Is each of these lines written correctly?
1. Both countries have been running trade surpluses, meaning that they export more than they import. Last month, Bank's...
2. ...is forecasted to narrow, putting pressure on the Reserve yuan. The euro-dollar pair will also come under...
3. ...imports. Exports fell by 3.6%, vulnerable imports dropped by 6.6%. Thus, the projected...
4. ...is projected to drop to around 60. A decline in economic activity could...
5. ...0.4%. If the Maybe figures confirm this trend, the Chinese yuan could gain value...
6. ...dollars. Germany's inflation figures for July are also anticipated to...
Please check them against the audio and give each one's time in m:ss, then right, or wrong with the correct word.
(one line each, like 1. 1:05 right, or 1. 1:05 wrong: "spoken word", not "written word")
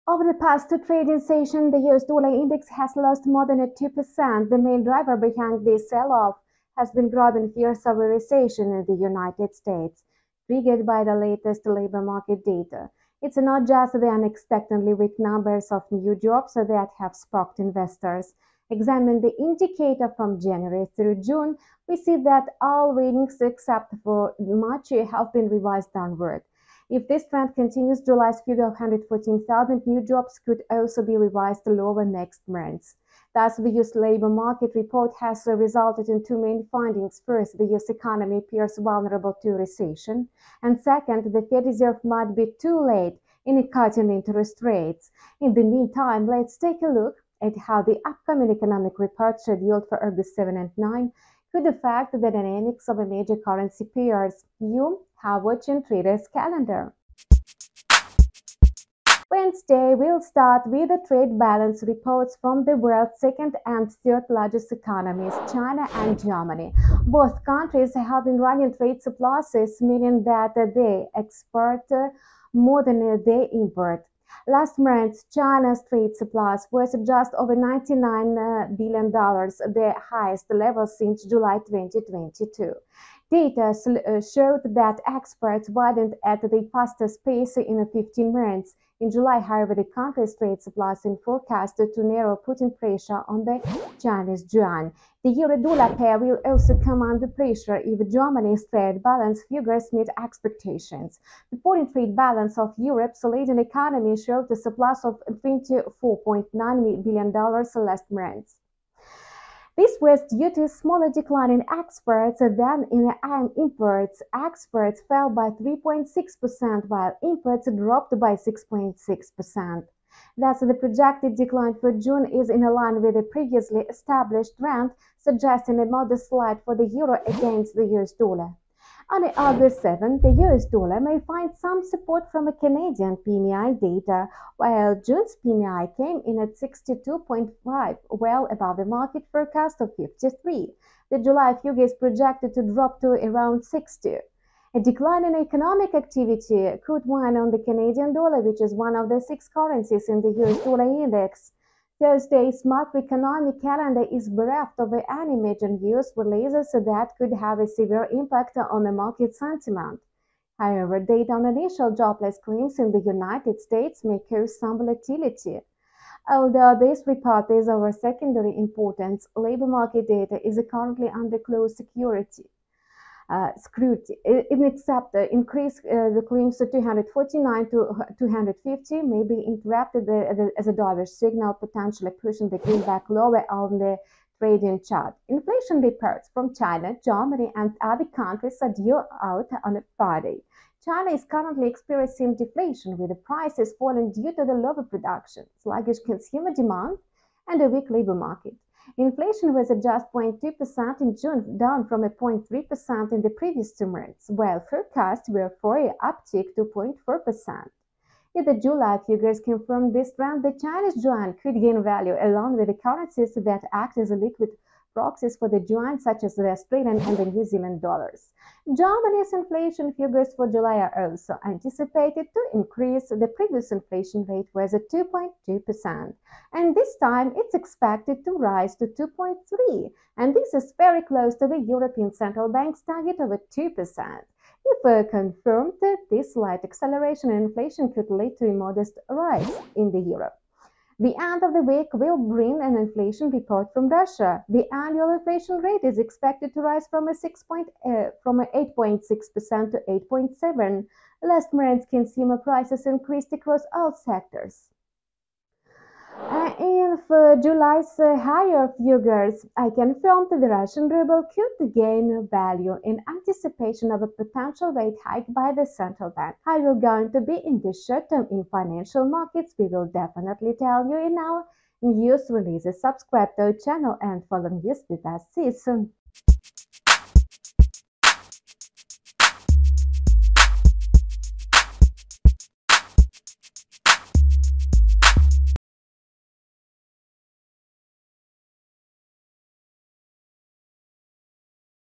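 1. 1:07 wrong: "China", not "Bank"
2. 1:31 wrong: "Chinese", not "Reserve"
3. 1:53 wrong: "while", not "vulnerable"
4. 2:21 right
5. 3:26 wrong: "July", not "Maybe"
6. 3:37 right.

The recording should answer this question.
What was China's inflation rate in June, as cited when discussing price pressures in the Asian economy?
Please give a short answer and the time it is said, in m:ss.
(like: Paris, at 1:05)
0.2%, at 3:20.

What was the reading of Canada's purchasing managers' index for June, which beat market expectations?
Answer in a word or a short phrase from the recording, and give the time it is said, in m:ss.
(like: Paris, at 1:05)
62.5, at 2:16.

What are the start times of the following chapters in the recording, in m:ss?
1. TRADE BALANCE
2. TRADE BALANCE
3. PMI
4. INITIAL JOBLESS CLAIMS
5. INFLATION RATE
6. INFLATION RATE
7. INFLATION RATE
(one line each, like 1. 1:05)
1. 0:59
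2. 1:35
3. 2:08
4. 2:31
5. 3:03
6. 3:38
7. 4:00.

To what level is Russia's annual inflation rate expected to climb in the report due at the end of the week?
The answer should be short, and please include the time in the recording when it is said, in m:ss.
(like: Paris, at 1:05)
8.7%, at 4:09.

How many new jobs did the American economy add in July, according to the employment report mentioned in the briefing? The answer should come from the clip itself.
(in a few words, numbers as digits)
114,000.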